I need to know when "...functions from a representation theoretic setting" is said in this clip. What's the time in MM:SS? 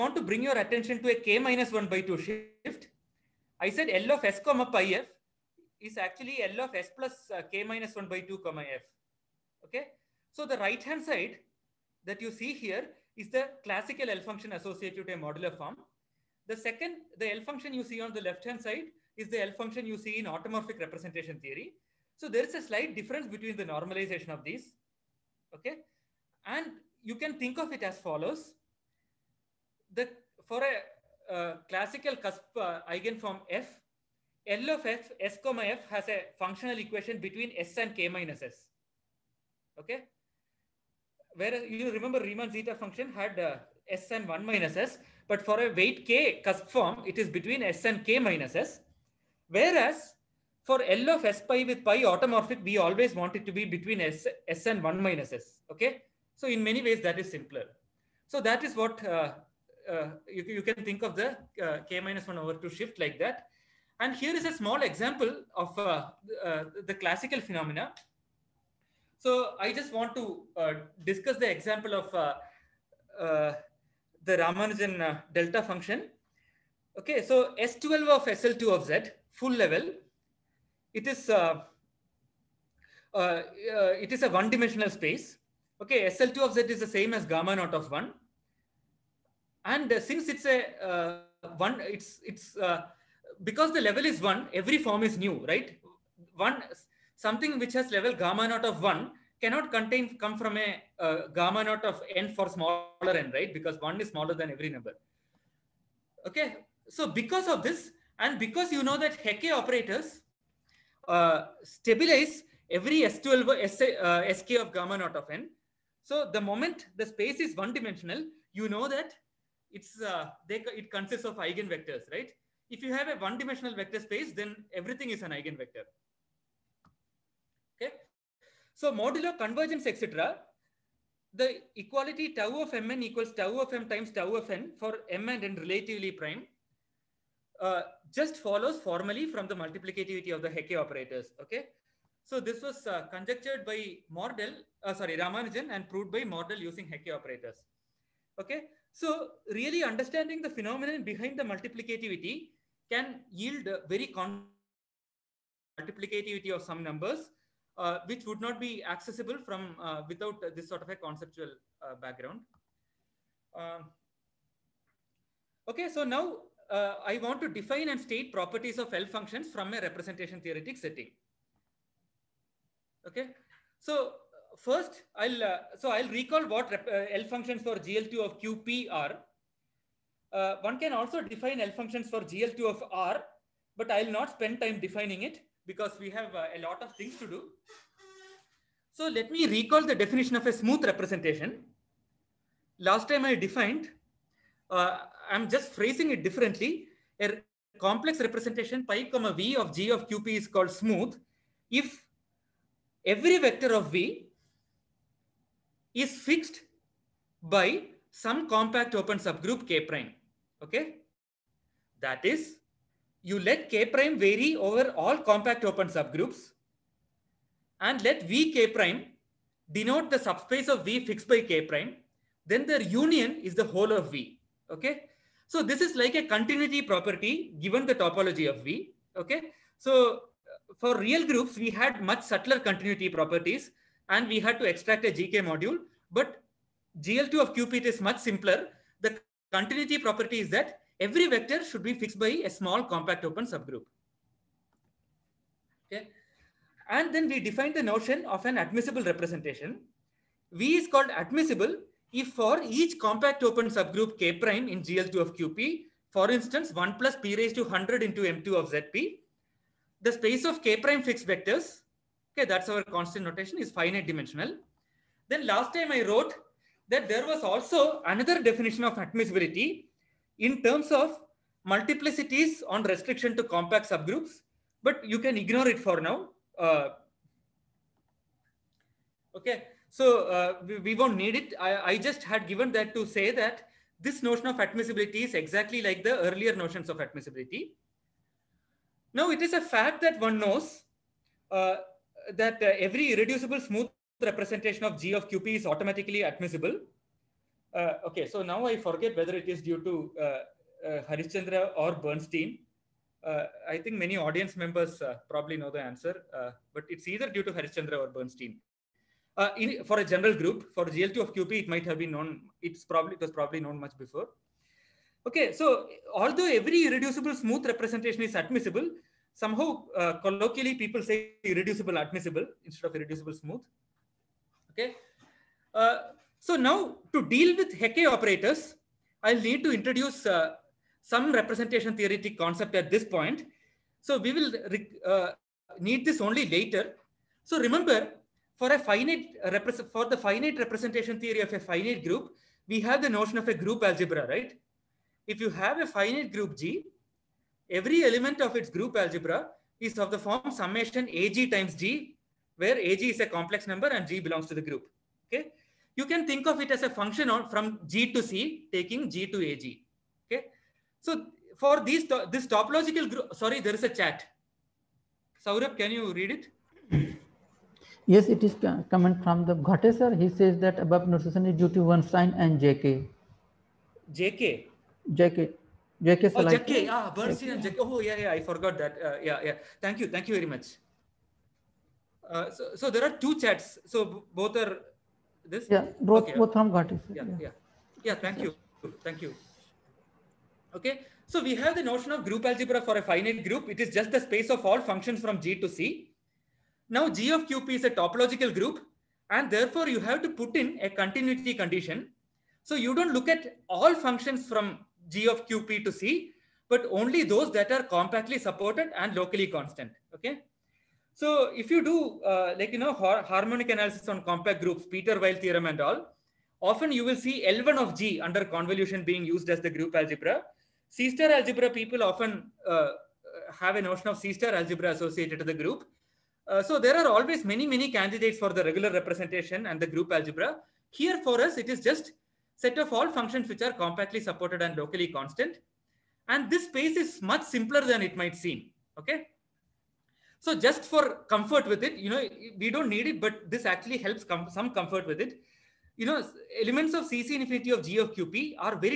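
02:49.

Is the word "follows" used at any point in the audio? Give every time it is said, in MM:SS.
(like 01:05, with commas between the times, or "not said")
00:27, 02:18.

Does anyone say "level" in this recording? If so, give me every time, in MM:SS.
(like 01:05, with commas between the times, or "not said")
01:19, 01:33, 01:37.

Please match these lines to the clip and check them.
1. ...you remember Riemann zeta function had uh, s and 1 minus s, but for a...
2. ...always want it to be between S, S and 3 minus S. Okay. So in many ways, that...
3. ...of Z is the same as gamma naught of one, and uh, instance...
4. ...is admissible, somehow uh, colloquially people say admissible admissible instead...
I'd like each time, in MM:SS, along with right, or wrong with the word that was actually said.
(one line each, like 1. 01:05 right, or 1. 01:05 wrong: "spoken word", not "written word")
1. 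00:41 right
2. 00:52 wrong: "1", not "3"
3. 01:26 wrong: "since", not "instance"
4. 05:18 wrong: "irreducible", not "admissible".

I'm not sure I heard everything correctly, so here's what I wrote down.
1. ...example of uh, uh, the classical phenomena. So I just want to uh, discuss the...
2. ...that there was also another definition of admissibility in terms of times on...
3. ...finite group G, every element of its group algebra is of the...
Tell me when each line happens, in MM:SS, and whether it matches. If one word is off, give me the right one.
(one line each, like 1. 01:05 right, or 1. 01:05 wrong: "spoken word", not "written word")
1. 01:04 right
2. 04:26 wrong: "multiplicities", not "times"
3. 05:45 right.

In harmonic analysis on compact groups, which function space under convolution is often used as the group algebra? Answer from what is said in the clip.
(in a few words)
L1 of G.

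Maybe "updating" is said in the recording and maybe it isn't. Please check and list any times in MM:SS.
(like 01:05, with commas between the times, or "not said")
not said.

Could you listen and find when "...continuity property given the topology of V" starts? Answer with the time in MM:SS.
03:46.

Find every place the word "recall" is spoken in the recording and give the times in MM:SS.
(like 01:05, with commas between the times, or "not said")
02:56, 03:09.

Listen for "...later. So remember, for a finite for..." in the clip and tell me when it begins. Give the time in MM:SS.
05:36.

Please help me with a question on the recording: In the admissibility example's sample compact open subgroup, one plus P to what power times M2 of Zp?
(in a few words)
100.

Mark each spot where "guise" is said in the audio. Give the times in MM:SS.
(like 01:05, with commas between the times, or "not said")
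not said.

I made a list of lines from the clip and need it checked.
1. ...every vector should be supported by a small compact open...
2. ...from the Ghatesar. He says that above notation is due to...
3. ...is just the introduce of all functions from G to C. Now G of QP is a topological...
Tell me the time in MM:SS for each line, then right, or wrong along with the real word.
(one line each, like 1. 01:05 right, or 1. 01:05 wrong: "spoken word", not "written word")
1. 04:00 wrong: "fixed", not "supported"
2. 06:09 right
3. 06:33 wrong: "space", not "introduce".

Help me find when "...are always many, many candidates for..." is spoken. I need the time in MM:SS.
07:06.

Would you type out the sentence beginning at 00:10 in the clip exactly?
So the right hand side that you see here is the classical L function associated to a modular form.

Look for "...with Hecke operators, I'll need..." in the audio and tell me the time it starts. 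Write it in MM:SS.
05:27.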